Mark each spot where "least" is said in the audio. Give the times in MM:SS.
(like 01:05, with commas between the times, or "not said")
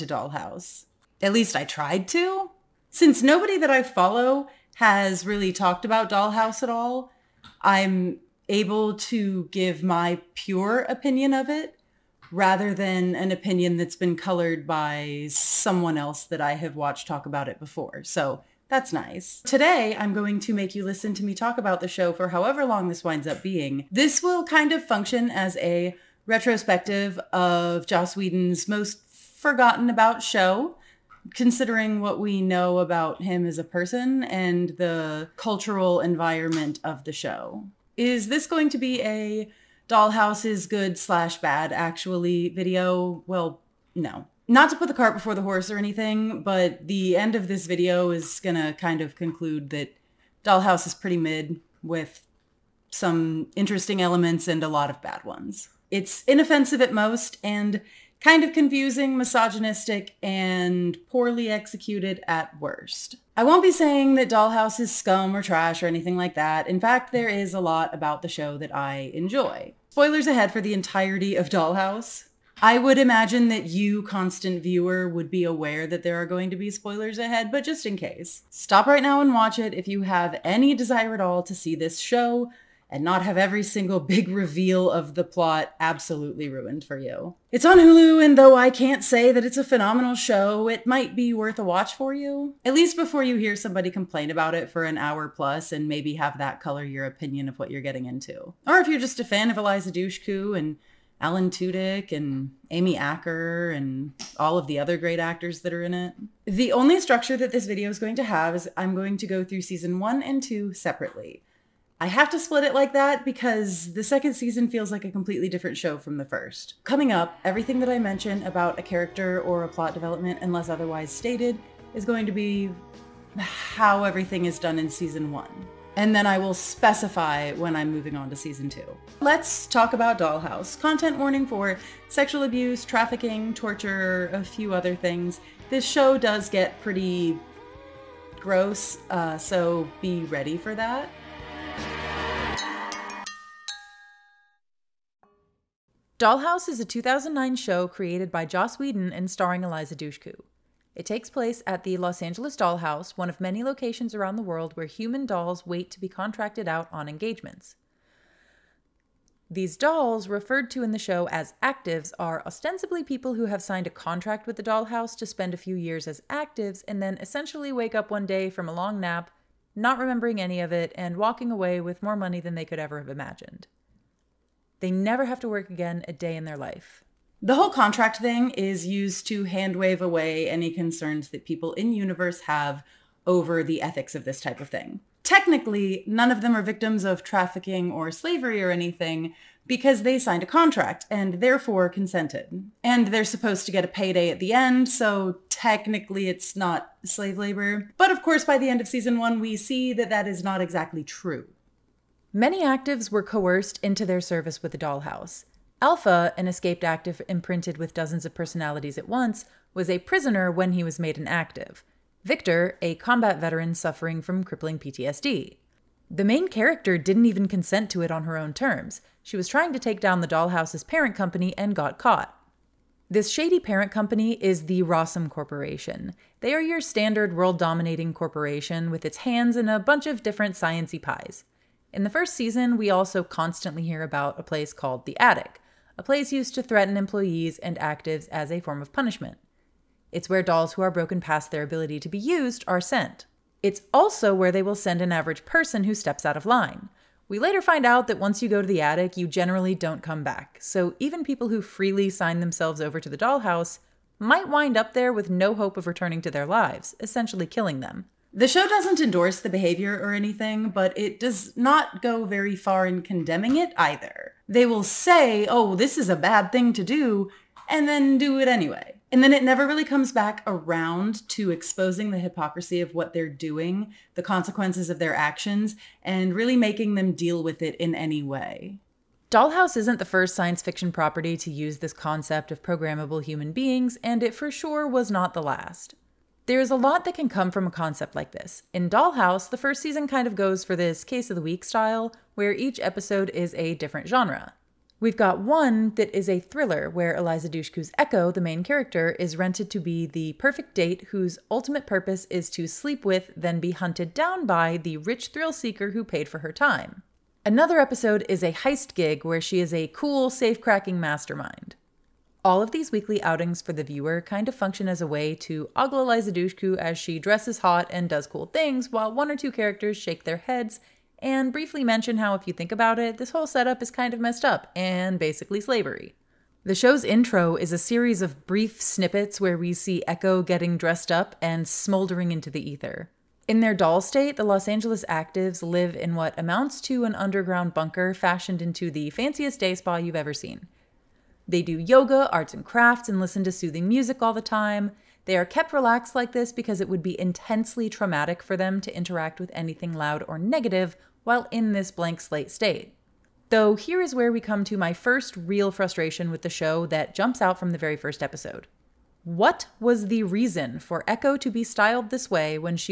00:01, 01:32.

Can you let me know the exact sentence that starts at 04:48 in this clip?
In Dollhouse, the first season kind of goes for this case of the week style, where each episode is a different genre.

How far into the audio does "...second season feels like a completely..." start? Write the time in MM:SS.
01:54.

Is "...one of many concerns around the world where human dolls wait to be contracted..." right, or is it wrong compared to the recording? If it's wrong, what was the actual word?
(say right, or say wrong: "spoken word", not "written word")
wrong: "locations", not "concerns".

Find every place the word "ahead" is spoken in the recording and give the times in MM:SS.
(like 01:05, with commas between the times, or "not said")
01:10, 01:17.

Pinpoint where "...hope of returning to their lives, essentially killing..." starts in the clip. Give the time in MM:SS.
04:15.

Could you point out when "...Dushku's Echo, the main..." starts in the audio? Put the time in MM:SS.
04:57.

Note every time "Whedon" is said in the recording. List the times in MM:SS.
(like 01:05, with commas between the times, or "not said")
00:28, 02:28.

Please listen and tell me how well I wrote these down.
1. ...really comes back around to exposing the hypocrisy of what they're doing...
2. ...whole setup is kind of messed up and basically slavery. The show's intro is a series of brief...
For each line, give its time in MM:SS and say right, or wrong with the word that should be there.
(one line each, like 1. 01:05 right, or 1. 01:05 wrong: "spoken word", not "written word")
1. 04:29 right
2. 05:23 right.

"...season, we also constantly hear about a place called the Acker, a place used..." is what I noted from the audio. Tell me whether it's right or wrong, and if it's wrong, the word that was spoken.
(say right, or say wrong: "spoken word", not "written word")
wrong: "Attic", not "Acker".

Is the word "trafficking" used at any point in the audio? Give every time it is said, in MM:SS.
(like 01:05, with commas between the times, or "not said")
02:12, 03:07.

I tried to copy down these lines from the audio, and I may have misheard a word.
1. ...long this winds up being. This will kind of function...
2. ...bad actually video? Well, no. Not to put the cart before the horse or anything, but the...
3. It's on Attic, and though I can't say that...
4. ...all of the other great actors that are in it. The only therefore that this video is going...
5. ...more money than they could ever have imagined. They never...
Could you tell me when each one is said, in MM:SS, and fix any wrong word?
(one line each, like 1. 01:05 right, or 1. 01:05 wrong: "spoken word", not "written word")
1. 00:22 right
2. 00:41 right
3. 01:27 wrong: "Hulu", not "Attic"
4. 01:44 wrong: "structure", not "therefore"
5. 02:52 right.